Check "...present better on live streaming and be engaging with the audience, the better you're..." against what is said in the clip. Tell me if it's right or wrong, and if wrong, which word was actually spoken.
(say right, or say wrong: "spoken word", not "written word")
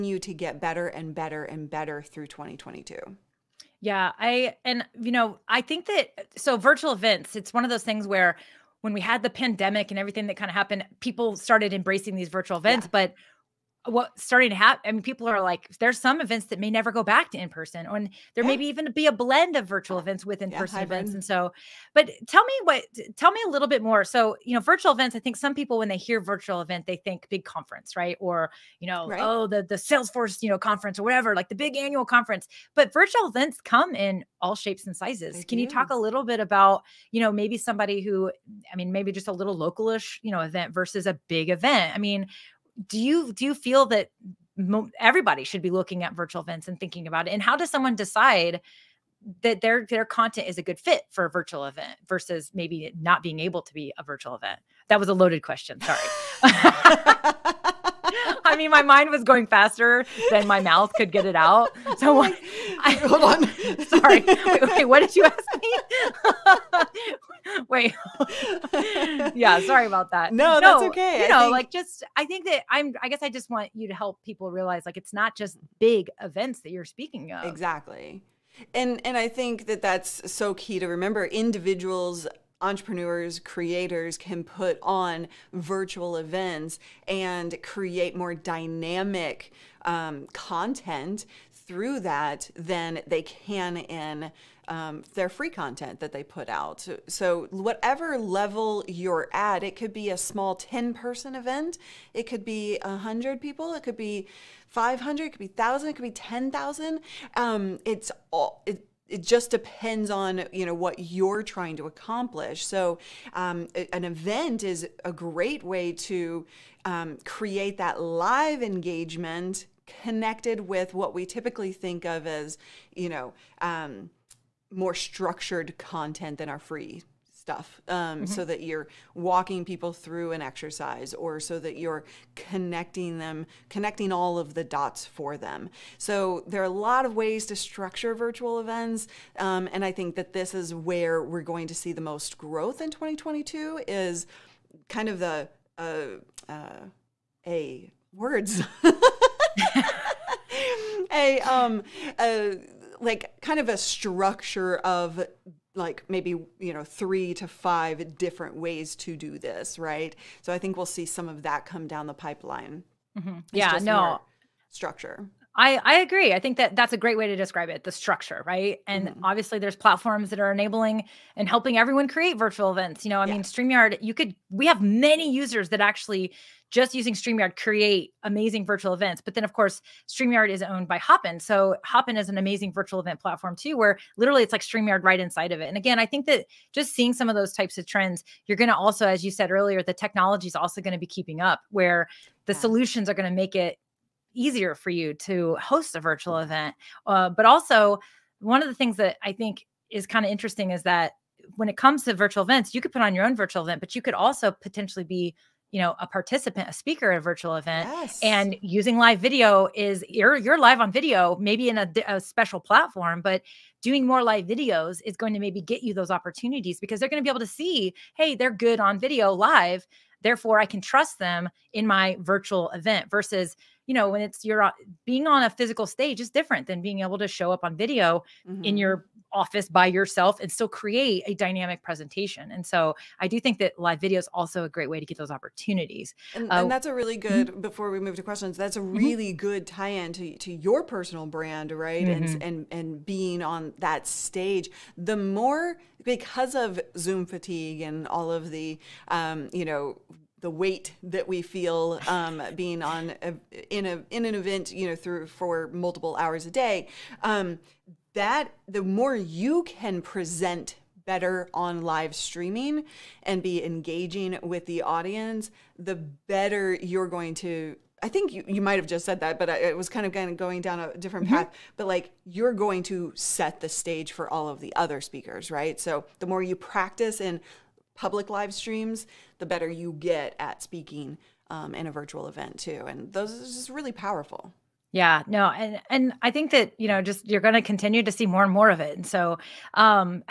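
right.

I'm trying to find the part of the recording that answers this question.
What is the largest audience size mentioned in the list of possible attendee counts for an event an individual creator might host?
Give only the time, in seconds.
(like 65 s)
106 s.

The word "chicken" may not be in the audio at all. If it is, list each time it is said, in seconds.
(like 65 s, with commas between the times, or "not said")
not said.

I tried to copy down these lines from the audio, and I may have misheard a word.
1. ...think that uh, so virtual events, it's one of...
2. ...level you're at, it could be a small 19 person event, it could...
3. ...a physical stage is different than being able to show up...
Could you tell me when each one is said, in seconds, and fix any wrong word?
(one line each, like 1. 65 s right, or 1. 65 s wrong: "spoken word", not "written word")
1. 5 s right
2. 98 s wrong: "10", not "19"
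3. 225 s right.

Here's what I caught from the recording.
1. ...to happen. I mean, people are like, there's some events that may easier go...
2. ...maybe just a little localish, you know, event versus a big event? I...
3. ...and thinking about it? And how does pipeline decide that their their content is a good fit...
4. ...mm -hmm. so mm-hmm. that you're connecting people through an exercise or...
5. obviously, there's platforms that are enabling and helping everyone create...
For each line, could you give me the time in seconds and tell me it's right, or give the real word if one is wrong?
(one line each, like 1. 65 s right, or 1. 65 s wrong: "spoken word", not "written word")
1. 14 s wrong: "never", not "easier"
2. 38 s right
3. 46 s wrong: "someone", not "pipeline"
4. 127 s wrong: "walking", not "connecting"
5. 169 s right.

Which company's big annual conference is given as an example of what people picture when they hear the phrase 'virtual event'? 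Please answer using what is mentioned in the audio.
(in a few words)
Salesforce.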